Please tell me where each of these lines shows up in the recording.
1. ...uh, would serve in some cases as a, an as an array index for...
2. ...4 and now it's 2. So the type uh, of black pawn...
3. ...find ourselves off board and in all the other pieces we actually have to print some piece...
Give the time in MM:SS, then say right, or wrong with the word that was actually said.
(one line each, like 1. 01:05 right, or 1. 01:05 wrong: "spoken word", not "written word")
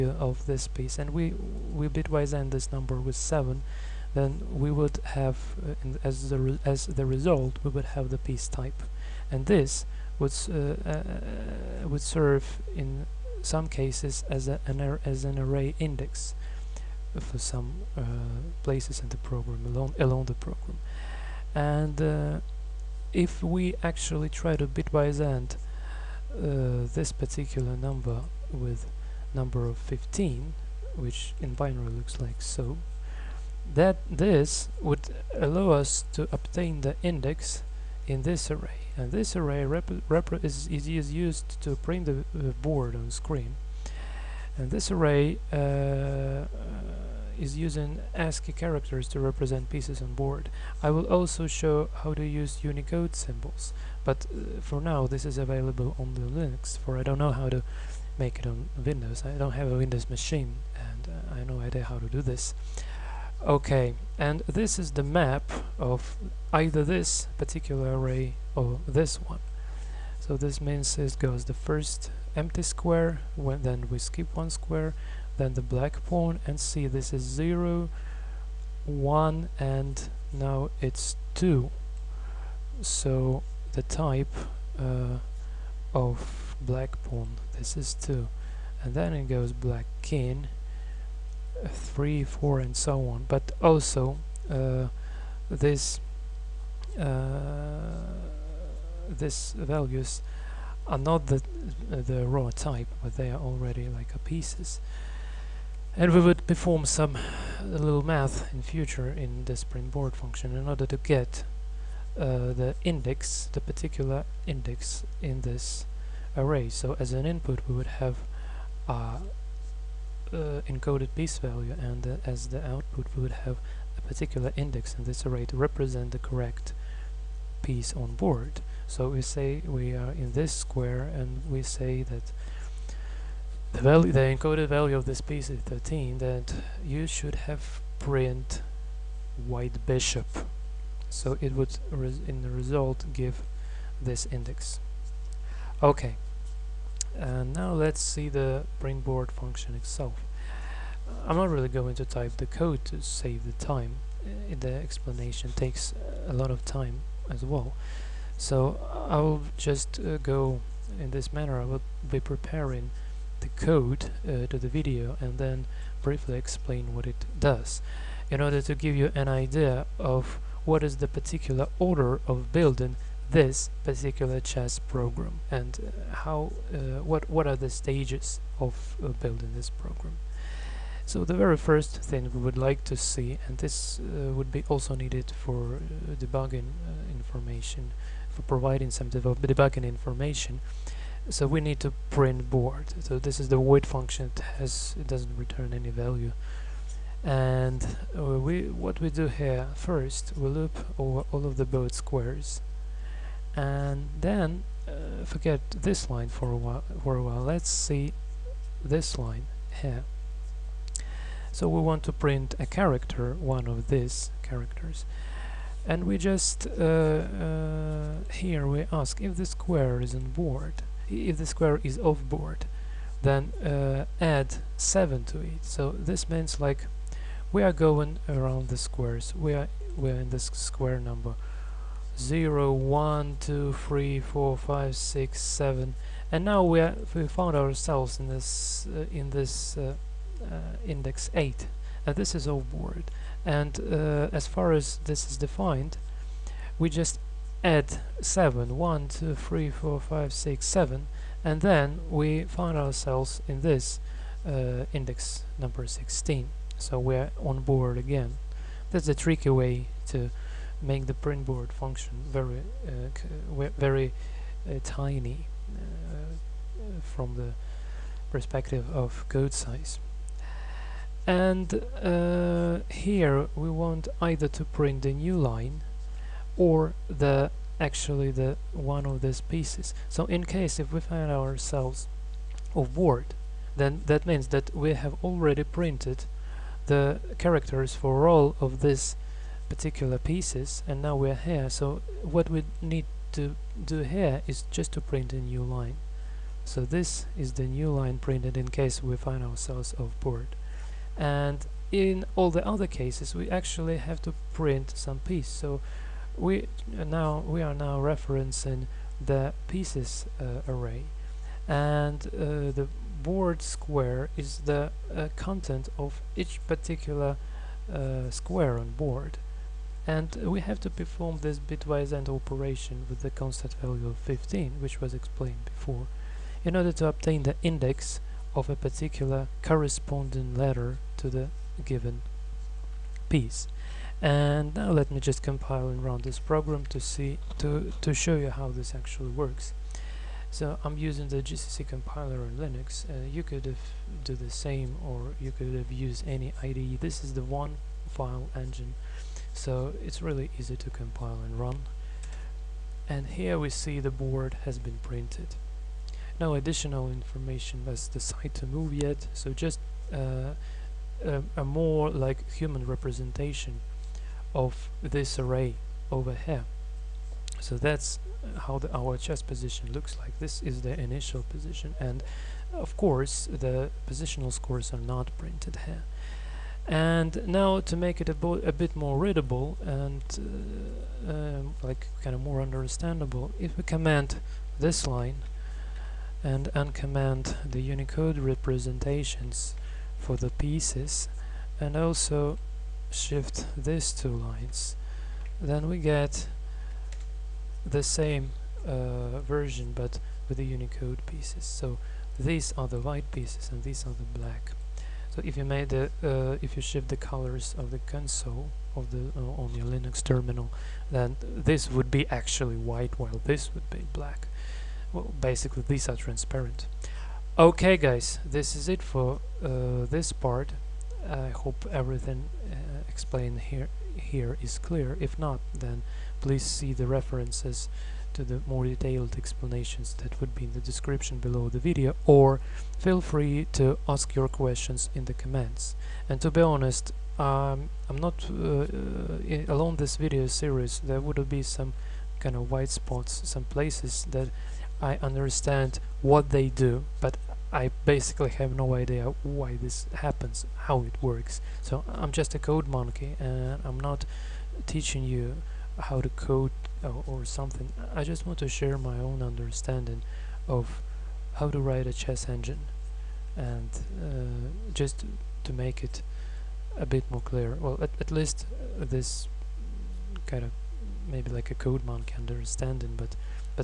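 1. 00:10 right
2. 01:18 wrong: "1", not "4"
3. 04:59 wrong: "cases", not "pieces".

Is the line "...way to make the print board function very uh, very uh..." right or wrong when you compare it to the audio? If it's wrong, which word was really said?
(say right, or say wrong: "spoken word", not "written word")
right.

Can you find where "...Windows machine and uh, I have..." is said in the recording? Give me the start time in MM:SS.
00:59.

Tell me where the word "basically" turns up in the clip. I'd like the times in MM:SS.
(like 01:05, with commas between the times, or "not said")
06:55, 07:28.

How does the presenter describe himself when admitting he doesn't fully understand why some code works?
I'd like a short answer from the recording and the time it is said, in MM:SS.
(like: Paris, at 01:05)
Code monkey, at 07:32.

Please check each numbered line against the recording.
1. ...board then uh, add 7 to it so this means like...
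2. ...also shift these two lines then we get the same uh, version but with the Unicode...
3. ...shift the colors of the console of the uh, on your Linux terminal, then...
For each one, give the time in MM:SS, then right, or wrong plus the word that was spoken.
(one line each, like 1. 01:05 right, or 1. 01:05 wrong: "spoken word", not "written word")
1. 03:42 right
2. 06:31 right
3. 06:46 right.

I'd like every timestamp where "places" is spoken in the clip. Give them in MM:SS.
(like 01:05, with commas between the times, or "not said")
00:18, 07:23.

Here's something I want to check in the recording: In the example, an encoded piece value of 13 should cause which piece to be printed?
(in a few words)
White bishop.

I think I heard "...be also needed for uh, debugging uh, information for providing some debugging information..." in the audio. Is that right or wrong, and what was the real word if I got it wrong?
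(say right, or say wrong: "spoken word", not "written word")
right.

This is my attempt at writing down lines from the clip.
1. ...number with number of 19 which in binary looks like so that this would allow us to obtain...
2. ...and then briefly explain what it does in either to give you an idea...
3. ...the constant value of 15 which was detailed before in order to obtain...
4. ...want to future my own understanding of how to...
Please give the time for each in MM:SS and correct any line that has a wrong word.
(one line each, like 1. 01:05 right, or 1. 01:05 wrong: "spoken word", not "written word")
1. 00:27 wrong: "15", not "19"
2. 02:45 wrong: "order", not "either"
3. 05:23 wrong: "explained", not "detailed"
4. 07:38 wrong: "share", not "future".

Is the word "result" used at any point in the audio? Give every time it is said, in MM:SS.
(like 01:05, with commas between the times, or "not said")
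00:07, 02:22.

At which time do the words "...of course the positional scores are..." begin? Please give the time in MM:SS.
06:12.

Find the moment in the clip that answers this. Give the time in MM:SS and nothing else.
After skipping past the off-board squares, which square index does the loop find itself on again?
04:15.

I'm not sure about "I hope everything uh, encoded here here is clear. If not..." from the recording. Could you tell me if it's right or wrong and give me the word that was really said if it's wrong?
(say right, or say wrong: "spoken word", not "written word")
wrong: "explained", not "encoded".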